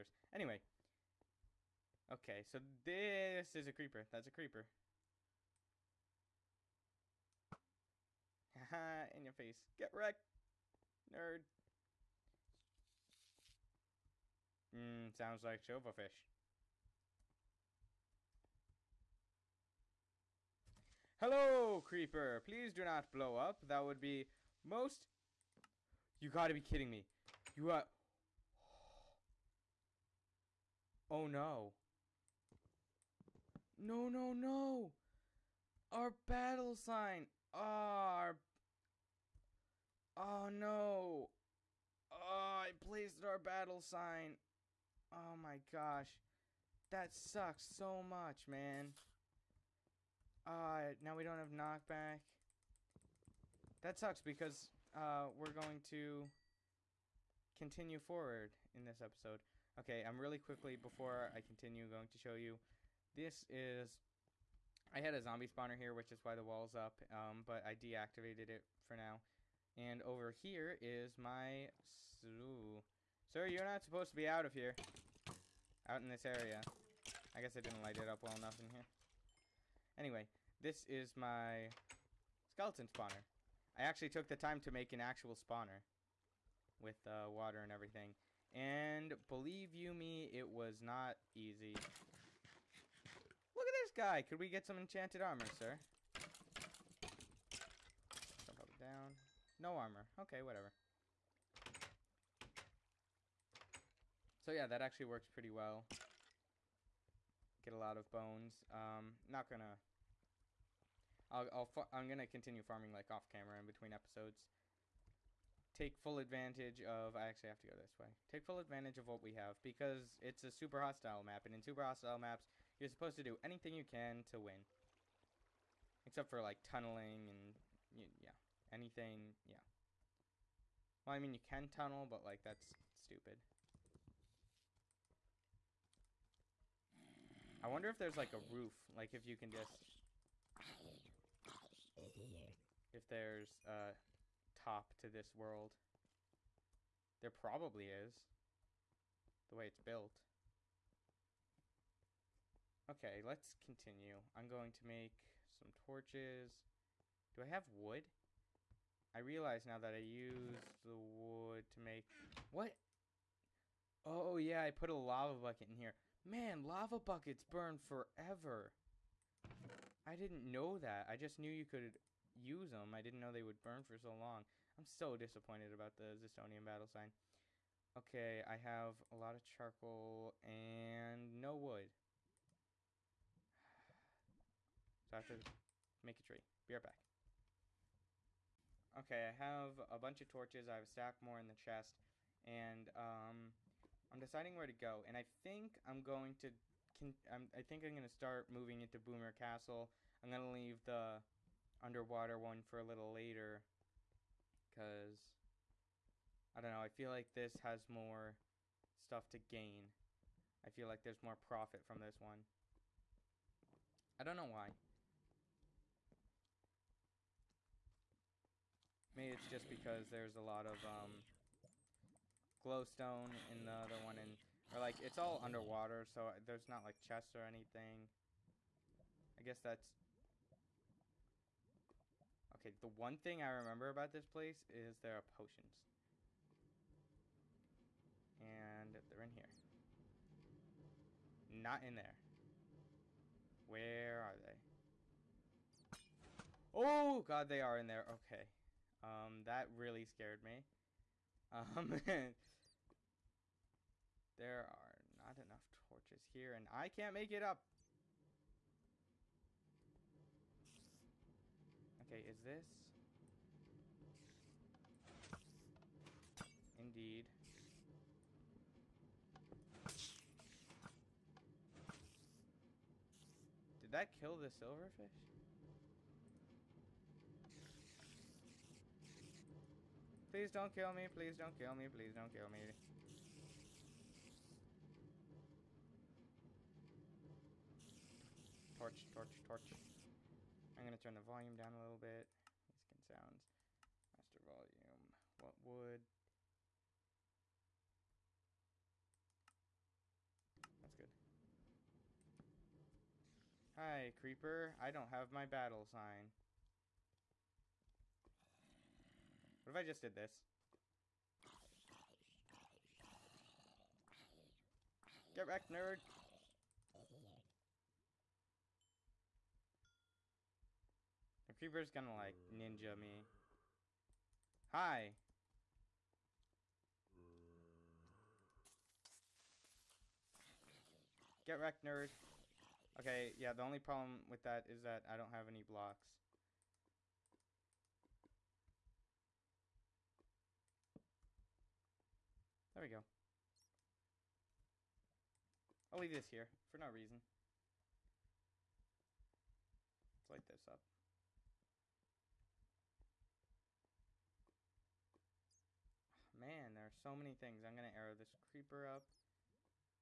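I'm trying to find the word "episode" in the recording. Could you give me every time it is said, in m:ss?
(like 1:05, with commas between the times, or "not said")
0:59, 1:53.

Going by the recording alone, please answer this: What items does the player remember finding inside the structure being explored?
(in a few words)
Potions.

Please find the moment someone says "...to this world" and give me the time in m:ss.
2:24.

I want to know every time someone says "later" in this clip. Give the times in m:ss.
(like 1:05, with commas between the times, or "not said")
3:23.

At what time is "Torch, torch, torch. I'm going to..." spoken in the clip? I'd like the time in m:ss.
4:48.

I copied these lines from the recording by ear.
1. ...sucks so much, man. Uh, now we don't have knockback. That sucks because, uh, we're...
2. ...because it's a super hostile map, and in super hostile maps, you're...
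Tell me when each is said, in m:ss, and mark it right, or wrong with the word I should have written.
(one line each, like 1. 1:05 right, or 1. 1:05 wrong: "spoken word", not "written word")
1. 0:47 right
2. 1:59 right.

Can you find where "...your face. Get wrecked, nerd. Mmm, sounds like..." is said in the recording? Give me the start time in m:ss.
0:09.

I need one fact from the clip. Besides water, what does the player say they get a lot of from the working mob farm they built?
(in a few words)
Bones.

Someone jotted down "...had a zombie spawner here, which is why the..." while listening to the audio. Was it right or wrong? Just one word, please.
right.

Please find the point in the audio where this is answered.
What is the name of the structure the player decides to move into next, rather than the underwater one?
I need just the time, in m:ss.
3:18.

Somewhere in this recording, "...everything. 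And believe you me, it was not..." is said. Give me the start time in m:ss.
1:27.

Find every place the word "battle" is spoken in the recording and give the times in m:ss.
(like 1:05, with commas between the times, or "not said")
0:36, 0:43, 2:56, 5:05.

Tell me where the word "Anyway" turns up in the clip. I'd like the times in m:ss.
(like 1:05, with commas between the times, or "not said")
0:00, 1:19.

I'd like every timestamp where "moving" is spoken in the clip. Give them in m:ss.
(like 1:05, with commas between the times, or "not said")
3:18.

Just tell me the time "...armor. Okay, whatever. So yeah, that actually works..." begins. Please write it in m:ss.
1:39.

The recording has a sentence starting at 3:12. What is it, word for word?
And um, I'm deciding where to go.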